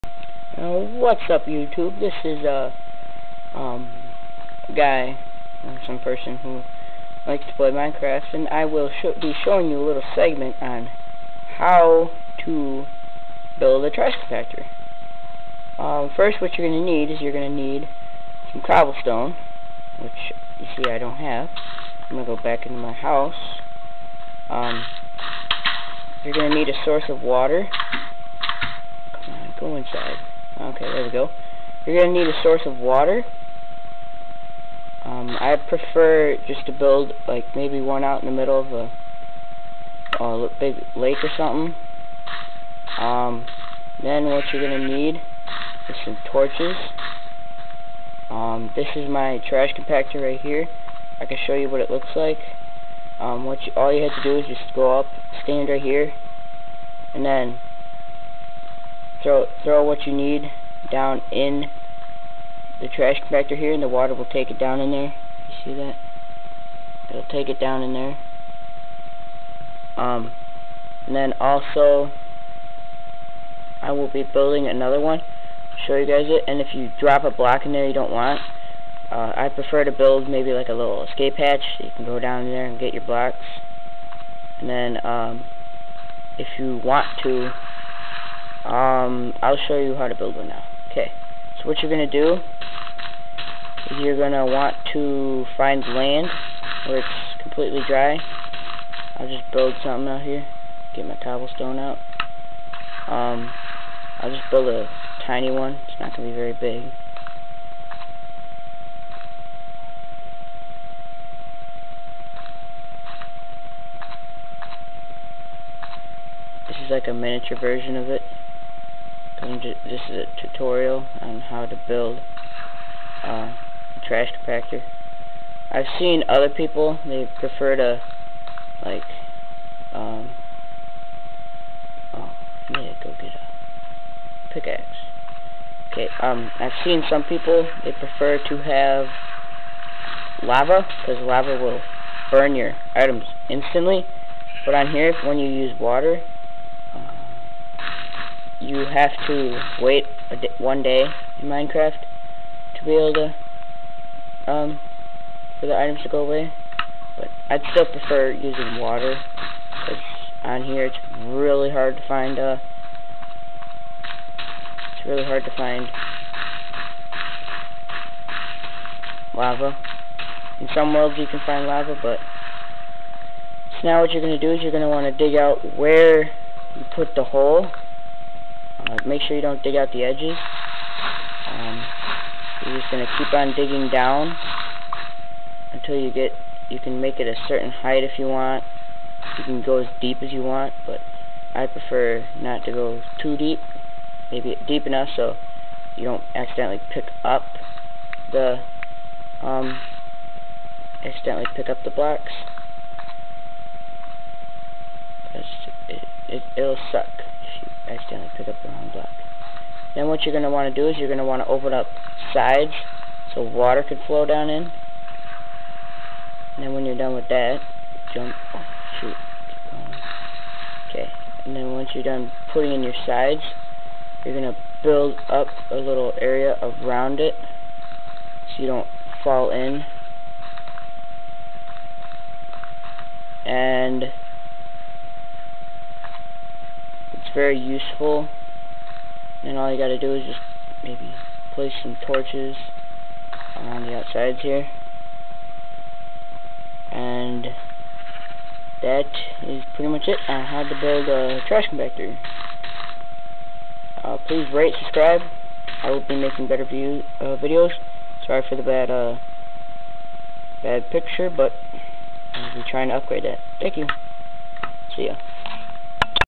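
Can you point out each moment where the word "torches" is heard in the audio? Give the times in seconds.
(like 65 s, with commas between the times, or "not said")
46 s, 242 s.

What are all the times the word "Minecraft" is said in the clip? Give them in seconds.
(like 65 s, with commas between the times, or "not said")
7 s, 151 s.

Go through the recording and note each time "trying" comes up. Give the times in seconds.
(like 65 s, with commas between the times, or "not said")
262 s.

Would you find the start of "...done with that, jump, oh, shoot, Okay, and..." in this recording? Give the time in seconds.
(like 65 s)
216 s.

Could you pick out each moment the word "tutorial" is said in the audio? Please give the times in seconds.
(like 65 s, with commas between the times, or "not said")
120 s.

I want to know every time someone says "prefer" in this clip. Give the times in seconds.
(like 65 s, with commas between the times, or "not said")
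35 s, 79 s, 127 s, 137 s, 157 s, 191 s.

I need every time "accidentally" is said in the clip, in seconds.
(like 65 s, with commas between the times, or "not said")
196 s, 201 s, 207 s.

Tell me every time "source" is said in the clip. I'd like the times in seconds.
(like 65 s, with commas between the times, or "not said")
26 s, 32 s.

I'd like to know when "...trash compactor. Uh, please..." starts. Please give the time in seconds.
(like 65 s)
251 s.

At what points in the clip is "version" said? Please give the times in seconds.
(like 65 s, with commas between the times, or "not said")
117 s.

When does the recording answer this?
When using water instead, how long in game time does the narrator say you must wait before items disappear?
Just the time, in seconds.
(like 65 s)
150 s.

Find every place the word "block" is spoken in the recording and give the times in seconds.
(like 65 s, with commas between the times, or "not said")
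77 s, 83 s, 201 s, 208 s.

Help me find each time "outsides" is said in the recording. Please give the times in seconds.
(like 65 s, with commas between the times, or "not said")
243 s.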